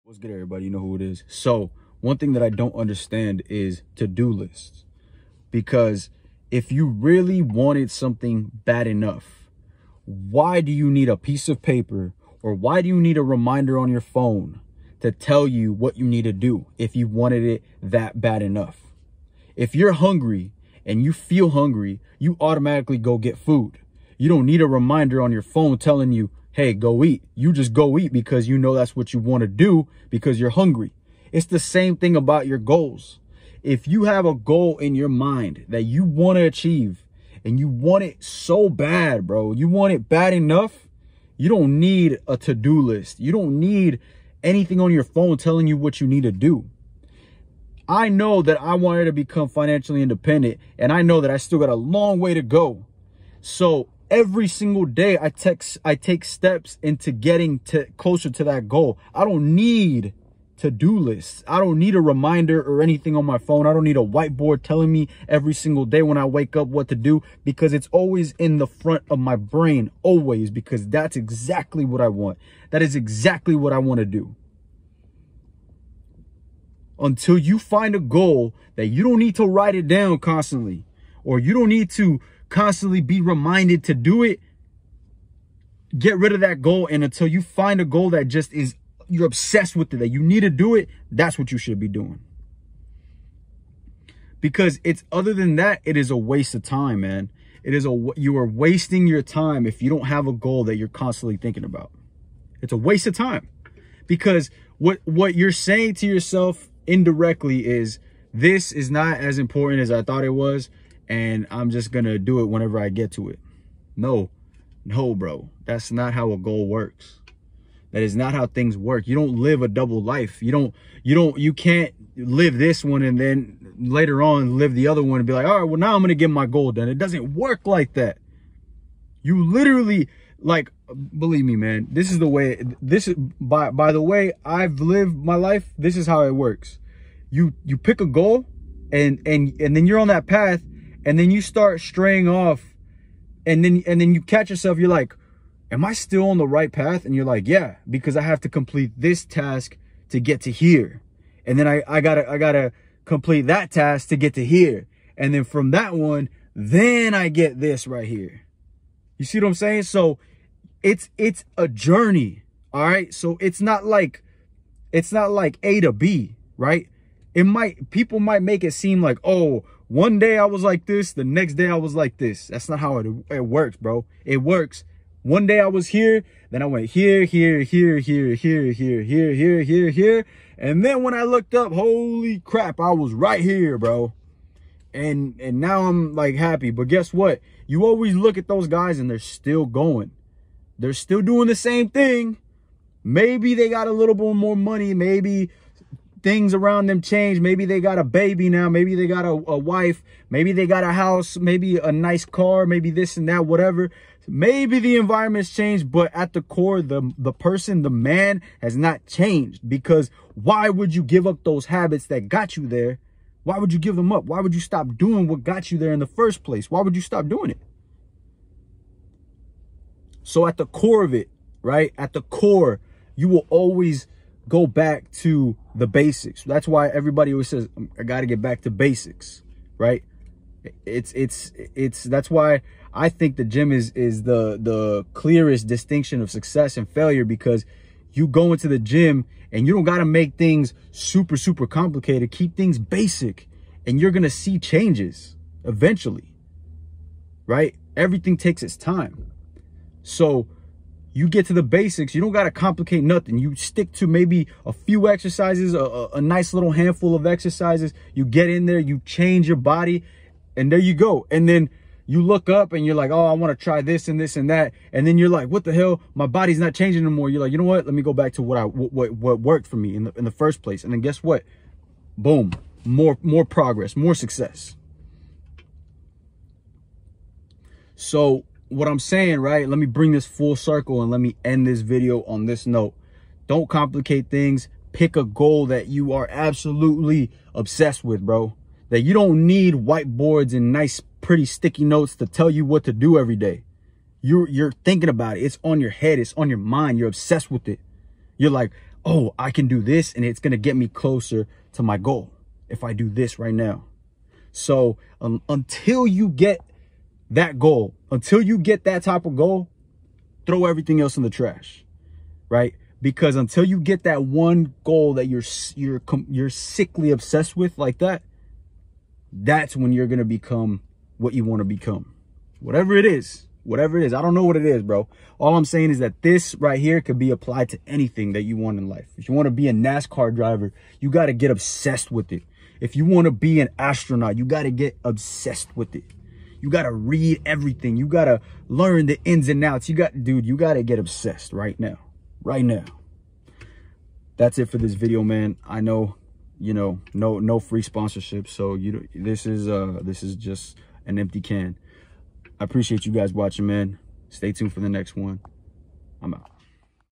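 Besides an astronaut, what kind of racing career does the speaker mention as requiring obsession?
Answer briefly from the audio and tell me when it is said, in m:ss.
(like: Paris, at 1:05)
NASCAR driver, at 5:29.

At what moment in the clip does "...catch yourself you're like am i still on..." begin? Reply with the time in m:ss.
2:24.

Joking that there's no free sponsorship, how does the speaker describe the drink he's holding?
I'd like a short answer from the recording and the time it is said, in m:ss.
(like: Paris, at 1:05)
An empty can, at 5:51.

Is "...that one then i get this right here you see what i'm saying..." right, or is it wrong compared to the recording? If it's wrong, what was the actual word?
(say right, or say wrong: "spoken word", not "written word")
right.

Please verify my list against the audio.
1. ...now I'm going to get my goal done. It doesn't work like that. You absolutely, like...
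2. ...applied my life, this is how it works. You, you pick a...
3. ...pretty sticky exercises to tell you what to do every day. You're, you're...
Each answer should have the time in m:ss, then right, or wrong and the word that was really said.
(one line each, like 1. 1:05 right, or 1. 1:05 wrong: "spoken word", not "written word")
1. 2:05 wrong: "literally", not "absolutely"
2. 2:14 wrong: "lived", not "applied"
3. 4:51 wrong: "notes", not "exercises".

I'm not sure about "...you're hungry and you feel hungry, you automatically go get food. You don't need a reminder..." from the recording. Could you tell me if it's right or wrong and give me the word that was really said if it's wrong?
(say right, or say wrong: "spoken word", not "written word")
right.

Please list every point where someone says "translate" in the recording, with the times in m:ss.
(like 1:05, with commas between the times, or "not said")
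not said.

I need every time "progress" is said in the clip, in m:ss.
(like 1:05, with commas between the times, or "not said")
4:33.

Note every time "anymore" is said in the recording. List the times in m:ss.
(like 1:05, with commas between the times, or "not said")
4:27.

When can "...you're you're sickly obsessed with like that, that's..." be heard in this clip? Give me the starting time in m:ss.
5:15.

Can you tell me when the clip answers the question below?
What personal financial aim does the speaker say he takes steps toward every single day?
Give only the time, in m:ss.
0:49.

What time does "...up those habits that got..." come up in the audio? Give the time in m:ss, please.
3:31.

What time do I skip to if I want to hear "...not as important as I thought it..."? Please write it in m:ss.
1:48.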